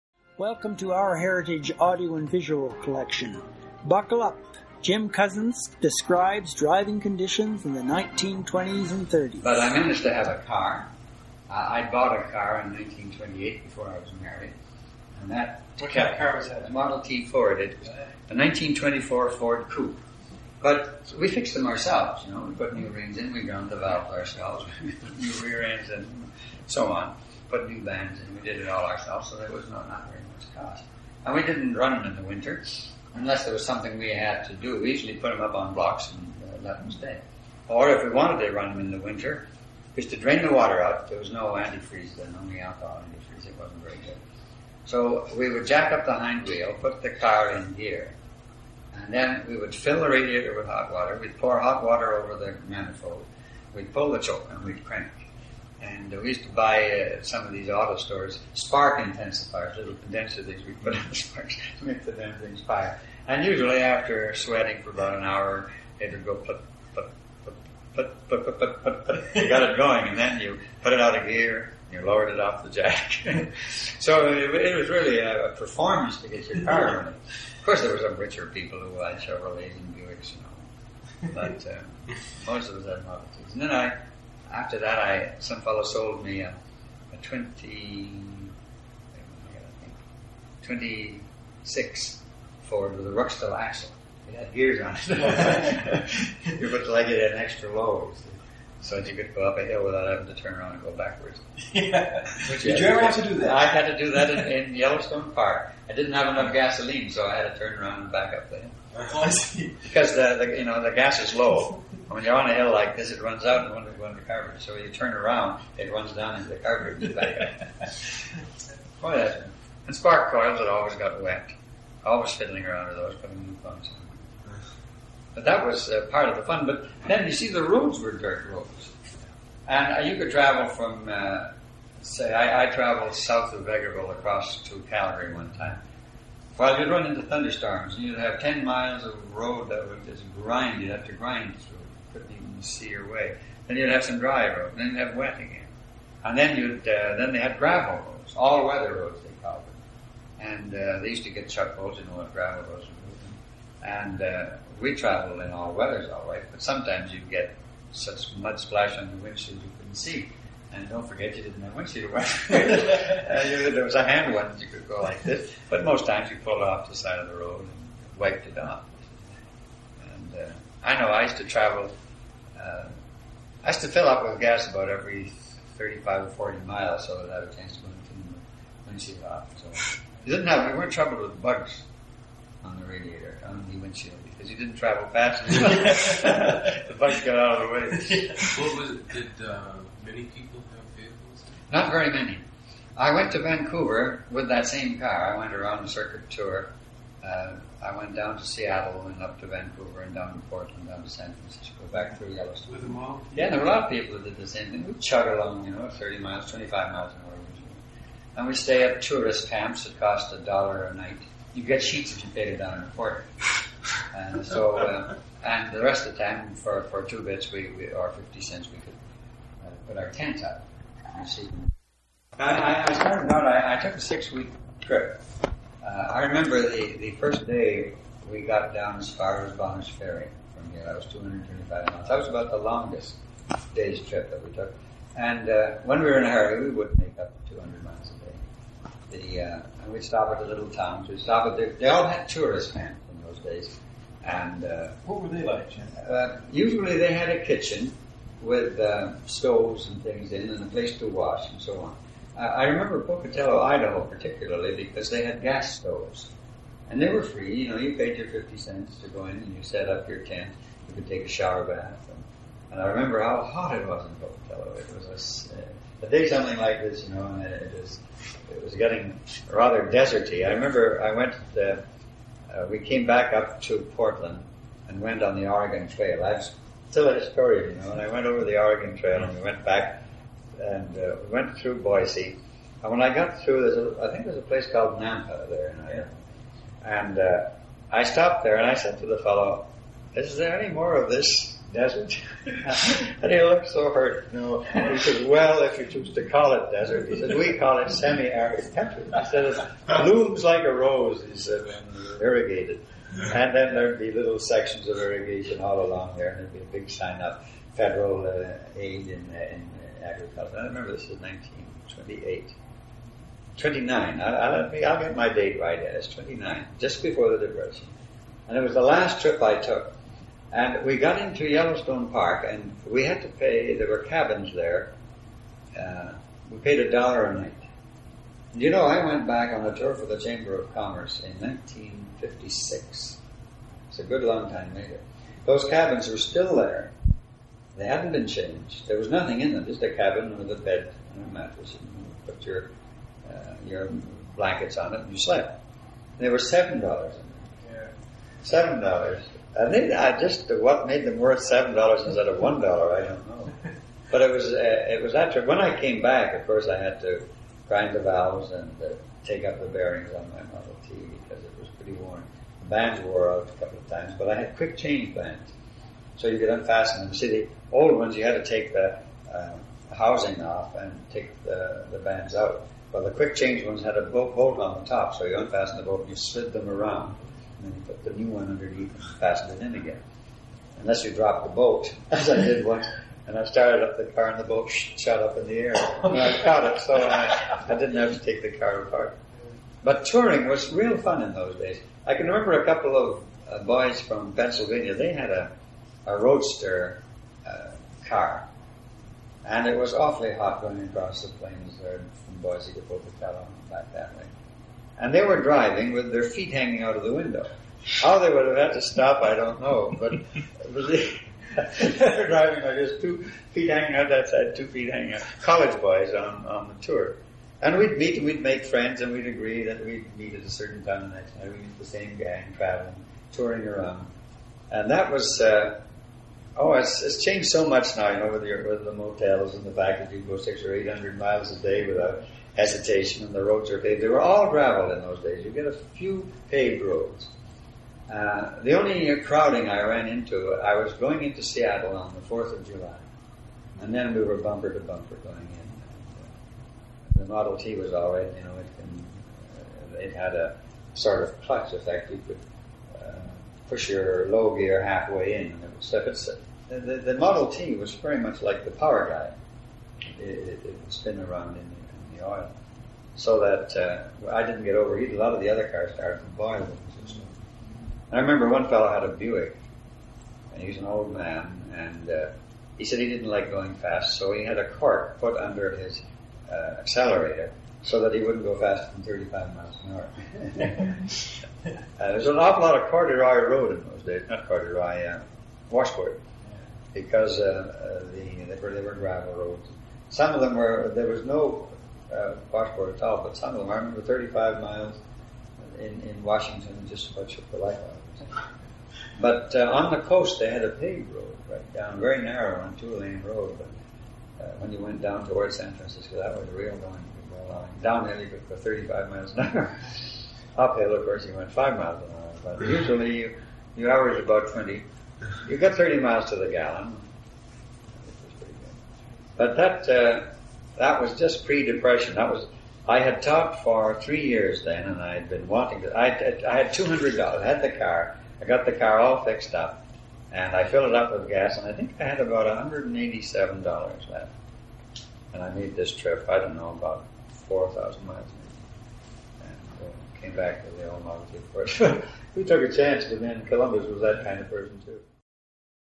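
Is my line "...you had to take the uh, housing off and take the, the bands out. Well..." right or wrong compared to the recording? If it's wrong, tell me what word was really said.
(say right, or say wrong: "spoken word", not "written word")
right.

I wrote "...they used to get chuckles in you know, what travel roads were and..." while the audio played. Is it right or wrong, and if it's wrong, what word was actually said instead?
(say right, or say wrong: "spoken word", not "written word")
wrong: "gravel", not "travel".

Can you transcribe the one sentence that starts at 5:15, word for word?
It's 29, just before the Depression.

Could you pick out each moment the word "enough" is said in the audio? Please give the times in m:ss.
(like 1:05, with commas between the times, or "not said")
1:46, 3:05.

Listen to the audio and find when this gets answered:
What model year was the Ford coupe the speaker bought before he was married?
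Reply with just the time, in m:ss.
0:18.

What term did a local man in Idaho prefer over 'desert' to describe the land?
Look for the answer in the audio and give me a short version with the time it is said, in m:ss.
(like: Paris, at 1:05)
Semi-arid country, at 4:57.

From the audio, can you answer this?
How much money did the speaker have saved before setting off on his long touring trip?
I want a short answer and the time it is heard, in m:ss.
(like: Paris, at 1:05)
$200, at 8:46.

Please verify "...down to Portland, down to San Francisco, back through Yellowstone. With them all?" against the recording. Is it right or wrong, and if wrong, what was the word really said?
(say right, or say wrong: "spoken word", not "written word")
right.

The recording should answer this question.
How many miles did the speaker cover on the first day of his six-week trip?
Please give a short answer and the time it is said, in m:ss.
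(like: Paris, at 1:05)
225, at 3:51.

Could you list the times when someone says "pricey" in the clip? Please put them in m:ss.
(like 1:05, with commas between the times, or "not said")
not said.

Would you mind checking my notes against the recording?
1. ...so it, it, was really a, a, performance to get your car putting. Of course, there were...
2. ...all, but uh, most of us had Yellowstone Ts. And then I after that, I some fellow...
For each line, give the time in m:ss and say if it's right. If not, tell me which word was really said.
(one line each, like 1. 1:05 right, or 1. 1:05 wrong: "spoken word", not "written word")
1. 1:13 wrong: "running", not "putting"
2. 1:21 wrong: "Model", not "Yellowstone".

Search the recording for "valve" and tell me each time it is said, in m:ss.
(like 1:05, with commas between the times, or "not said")
0:23, 5:58.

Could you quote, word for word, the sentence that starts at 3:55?
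And uh, when we were in a hurry, we would make up 200 miles a day.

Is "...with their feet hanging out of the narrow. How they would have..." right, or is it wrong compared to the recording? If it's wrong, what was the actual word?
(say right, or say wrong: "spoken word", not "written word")
wrong: "window", not "narrow".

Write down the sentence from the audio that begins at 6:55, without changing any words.
College boys on, on the tour.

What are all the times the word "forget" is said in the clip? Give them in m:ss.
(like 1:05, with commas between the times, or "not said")
2:41.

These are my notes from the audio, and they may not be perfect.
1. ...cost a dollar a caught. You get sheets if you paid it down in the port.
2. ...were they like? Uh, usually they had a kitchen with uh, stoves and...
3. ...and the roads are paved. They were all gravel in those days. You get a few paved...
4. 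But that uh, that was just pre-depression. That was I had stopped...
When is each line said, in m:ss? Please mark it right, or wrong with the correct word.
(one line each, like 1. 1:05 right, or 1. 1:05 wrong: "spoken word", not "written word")
1. 3:29 wrong: "night", not "caught"
2. 4:05 right
3. 7:13 right
4. 8:39 wrong: "talked", not "stopped".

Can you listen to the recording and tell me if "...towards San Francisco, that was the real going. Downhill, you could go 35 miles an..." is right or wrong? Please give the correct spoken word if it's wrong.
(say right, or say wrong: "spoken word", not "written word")
right.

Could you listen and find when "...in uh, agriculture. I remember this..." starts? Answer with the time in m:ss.
5:09.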